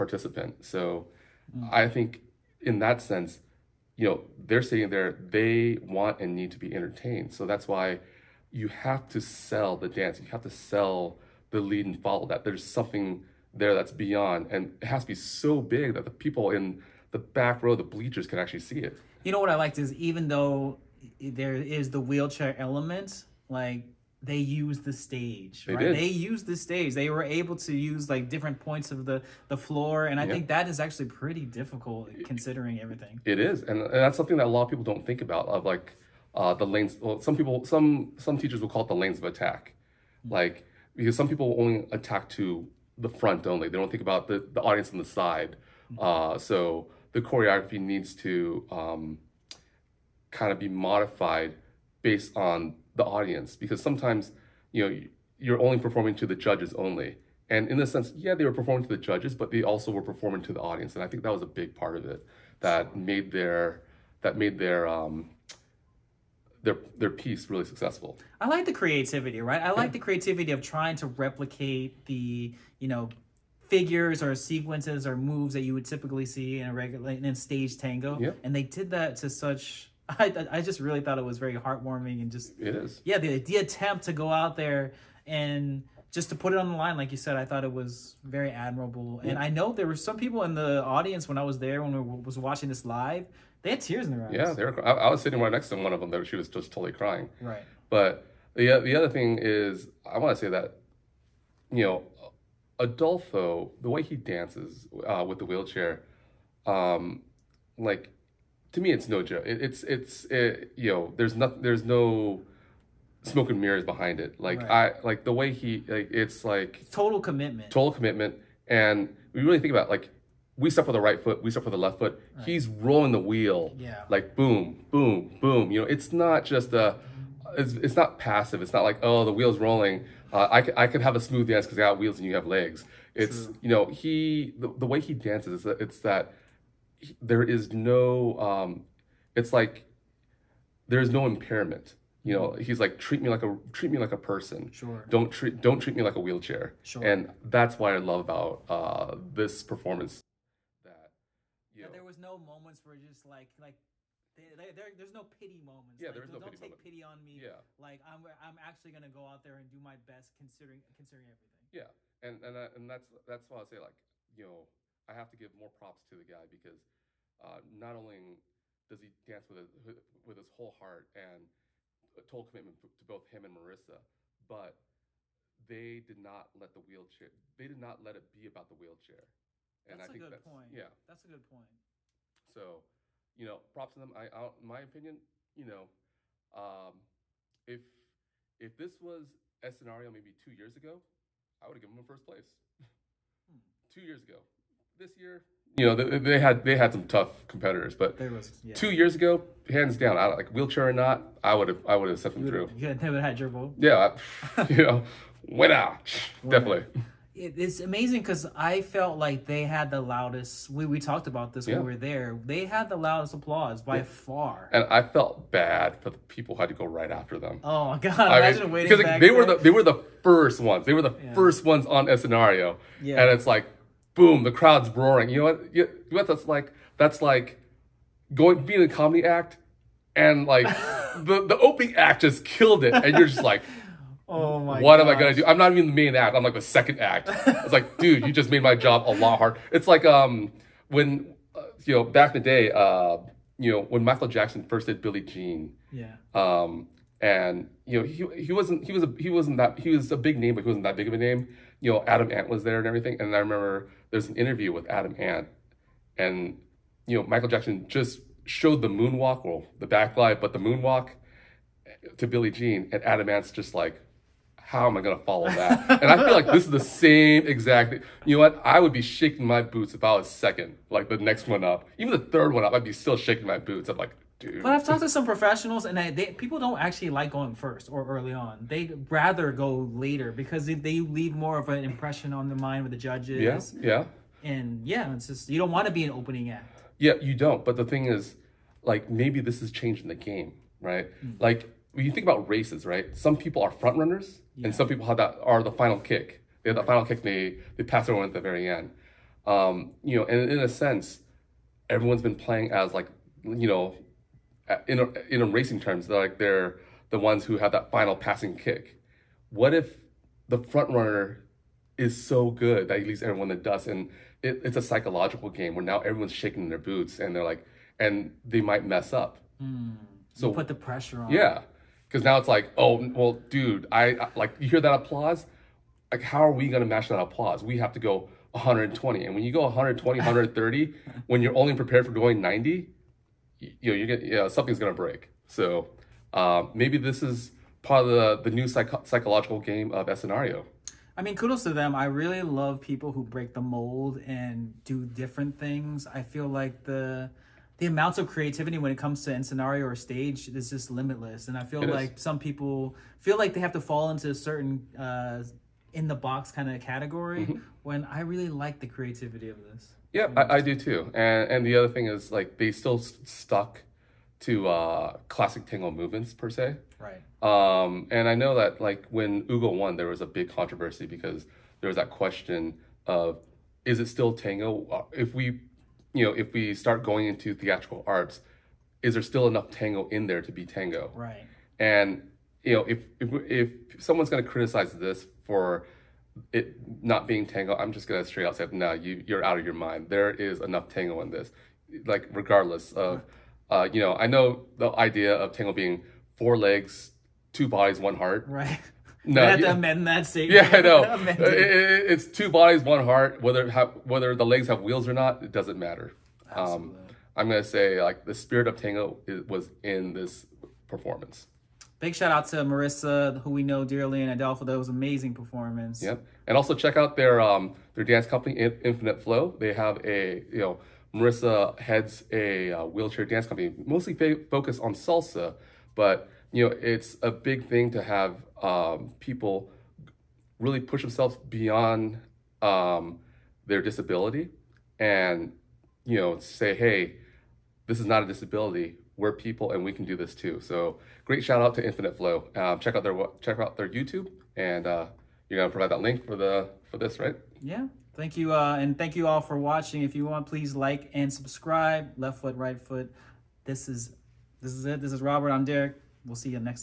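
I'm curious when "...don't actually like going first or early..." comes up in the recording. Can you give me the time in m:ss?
4:36.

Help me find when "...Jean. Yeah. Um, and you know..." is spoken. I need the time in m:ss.
4:05.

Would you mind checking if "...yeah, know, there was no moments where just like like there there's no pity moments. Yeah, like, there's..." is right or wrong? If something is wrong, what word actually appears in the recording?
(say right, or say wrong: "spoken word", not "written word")
right.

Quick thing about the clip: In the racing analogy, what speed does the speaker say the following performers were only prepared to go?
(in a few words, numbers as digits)
90.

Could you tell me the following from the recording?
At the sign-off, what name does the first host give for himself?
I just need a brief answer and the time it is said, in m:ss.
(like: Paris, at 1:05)
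Robert, at 7:35.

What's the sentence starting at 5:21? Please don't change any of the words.
Yeah, because now it's like, oh well, dude, I, I like you hear that applause.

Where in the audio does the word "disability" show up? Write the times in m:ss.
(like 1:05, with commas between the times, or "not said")
7:13, 7:18.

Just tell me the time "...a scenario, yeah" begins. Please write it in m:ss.
3:42.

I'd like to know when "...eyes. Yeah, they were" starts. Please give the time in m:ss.
1:34.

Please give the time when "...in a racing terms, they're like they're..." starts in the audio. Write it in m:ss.
5:05.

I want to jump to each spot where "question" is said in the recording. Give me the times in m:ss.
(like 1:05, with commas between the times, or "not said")
6:12.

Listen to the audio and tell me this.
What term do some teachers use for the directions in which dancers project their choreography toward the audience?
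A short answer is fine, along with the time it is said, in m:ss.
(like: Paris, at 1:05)
lanes of attack, at 0:38.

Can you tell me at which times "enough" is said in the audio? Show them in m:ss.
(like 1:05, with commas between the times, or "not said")
6:19, 6:30.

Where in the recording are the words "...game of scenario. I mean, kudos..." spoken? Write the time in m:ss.
5:39.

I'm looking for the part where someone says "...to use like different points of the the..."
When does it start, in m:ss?
0:27.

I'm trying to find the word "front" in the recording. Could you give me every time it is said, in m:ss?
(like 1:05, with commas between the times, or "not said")
0:43, 4:53, 5:10.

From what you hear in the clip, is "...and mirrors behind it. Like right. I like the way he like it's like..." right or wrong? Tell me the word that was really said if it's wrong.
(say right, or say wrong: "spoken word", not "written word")
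right.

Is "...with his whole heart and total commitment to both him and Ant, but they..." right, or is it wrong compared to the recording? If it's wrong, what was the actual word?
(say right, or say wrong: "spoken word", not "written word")
wrong: "Marissa", not "Ant".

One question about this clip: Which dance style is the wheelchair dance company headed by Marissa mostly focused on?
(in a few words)
salsa.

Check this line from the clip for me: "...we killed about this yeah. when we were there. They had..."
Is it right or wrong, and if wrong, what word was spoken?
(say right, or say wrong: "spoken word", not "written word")
wrong: "talked", not "killed".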